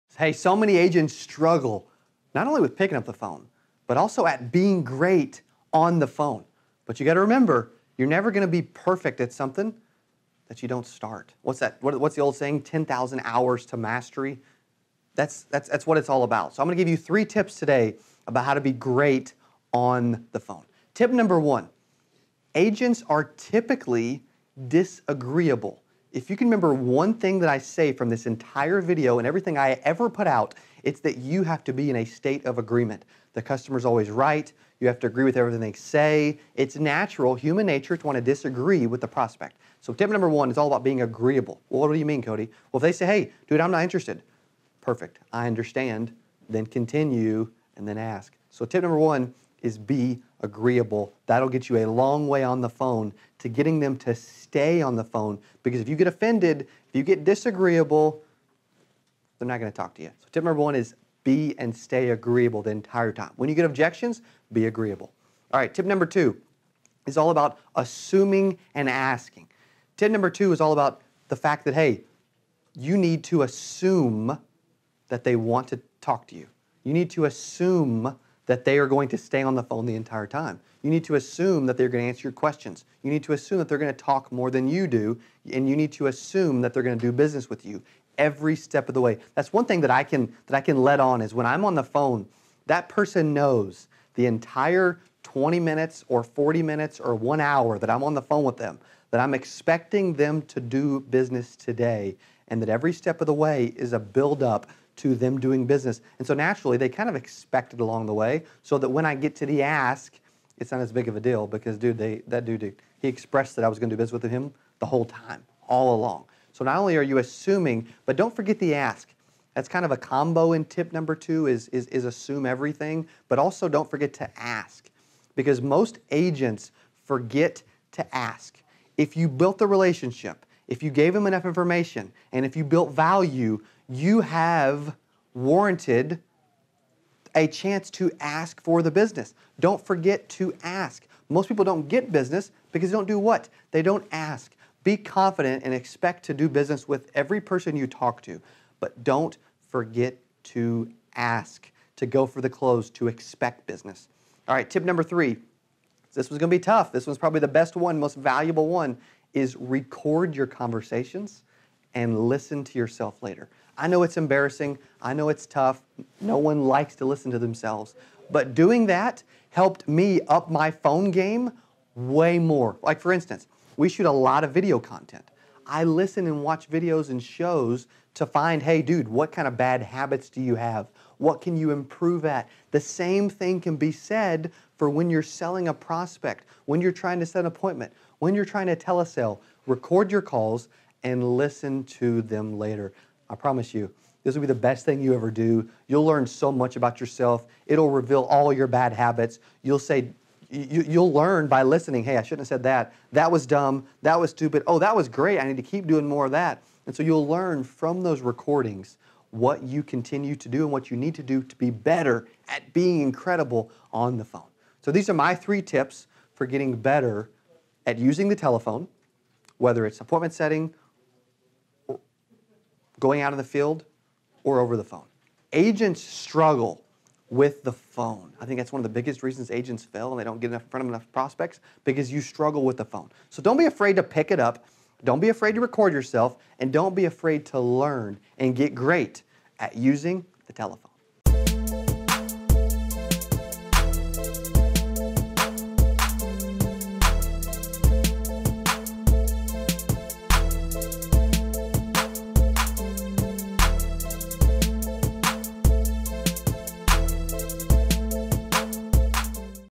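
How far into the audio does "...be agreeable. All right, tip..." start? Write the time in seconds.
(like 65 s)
64 s.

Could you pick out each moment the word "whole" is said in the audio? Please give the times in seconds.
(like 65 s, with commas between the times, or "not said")
114 s.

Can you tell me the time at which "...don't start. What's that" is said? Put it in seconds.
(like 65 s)
10 s.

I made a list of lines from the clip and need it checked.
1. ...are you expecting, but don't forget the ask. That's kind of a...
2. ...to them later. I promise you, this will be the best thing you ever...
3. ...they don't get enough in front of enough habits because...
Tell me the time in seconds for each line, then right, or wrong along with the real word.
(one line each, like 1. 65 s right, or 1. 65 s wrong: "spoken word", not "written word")
1. 116 s wrong: "assuming", not "expecting"
2. 191 s right
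3. 230 s wrong: "prospects", not "habits".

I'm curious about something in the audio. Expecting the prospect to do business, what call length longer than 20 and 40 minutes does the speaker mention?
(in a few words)
1 hour.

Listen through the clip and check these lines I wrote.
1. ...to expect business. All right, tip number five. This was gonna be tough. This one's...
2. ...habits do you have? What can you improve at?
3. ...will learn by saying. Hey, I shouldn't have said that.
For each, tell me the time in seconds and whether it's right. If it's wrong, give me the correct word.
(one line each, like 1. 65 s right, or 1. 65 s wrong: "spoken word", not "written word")
1. 152 s wrong: "three", not "five"
2. 179 s right
3. 200 s wrong: "listening", not "saying".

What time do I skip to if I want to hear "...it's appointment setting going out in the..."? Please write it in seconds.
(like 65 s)
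219 s.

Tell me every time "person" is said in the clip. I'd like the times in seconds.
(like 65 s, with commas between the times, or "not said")
92 s, 147 s.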